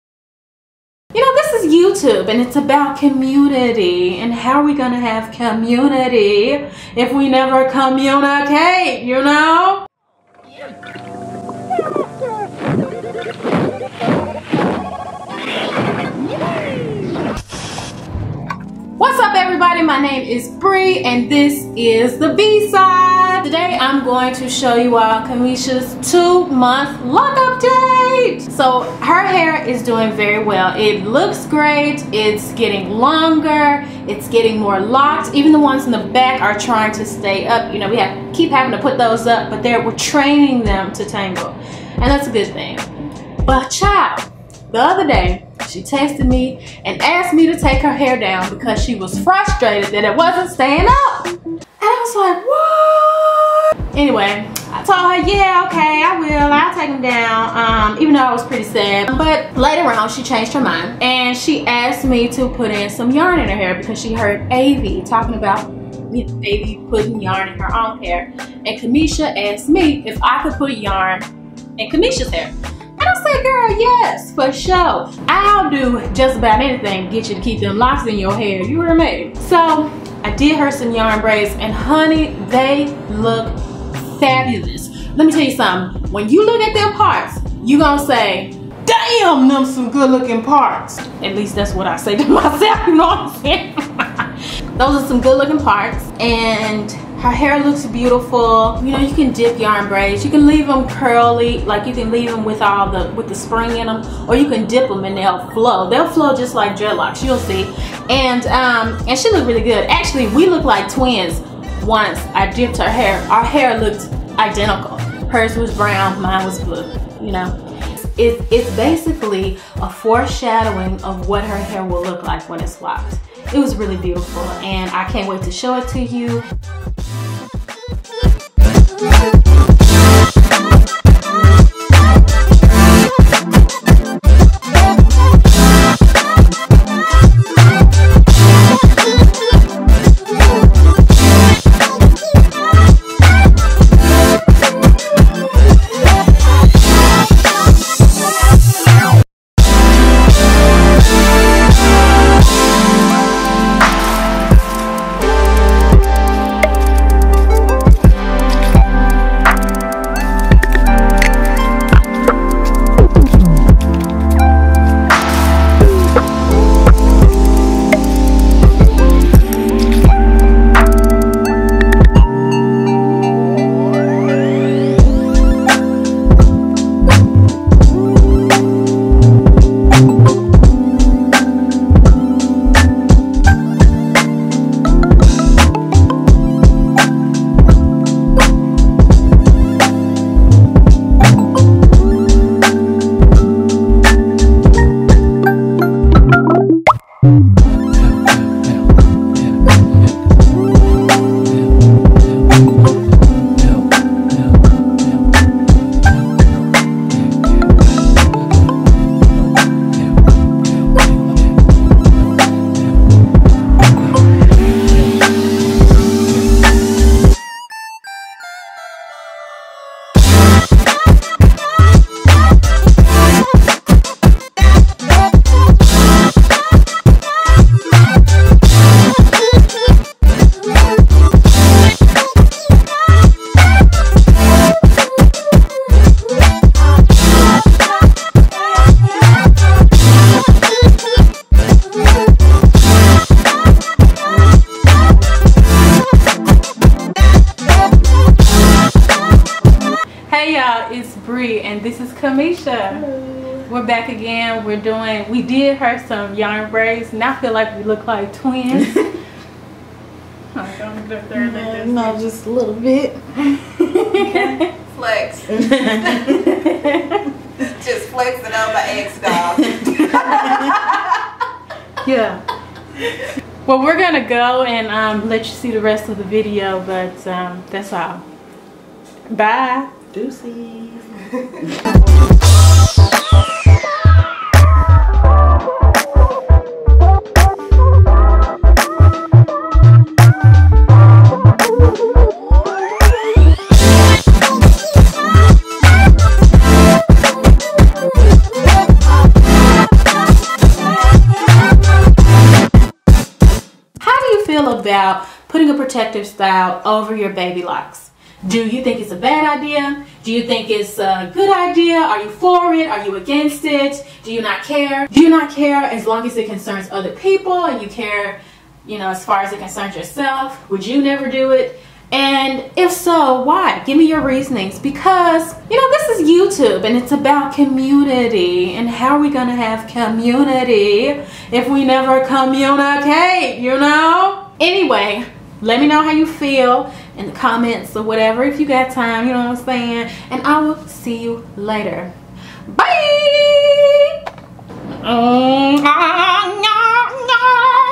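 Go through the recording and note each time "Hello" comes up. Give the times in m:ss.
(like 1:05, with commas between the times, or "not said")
4:13.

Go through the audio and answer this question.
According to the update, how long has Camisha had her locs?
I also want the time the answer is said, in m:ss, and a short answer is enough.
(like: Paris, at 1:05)
two month, at 0:26.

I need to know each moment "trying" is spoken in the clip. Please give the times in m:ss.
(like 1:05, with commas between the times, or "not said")
0:36.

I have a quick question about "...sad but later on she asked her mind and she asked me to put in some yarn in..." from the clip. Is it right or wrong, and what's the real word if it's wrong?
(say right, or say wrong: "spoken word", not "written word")
wrong: "changed", not "asked".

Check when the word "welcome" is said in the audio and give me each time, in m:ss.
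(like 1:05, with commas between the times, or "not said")
not said.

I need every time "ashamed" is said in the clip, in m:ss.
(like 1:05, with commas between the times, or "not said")
not said.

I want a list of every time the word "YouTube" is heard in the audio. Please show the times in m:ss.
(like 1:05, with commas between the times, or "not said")
0:01, 5:26.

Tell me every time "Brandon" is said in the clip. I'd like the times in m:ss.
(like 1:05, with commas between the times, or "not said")
not said.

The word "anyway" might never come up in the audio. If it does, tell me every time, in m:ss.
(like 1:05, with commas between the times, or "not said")
0:53, 5:34.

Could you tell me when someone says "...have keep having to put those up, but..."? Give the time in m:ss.
0:37.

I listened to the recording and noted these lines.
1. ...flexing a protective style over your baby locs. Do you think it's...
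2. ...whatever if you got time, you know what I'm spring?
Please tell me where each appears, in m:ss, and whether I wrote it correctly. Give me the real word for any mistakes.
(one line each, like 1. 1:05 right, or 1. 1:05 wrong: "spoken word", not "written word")
1. 5:05 wrong: "putting", not "flexing"
2. 5:38 wrong: "saying", not "spring".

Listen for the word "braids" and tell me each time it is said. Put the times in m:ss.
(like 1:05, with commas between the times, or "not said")
1:21, 1:39, 4:16.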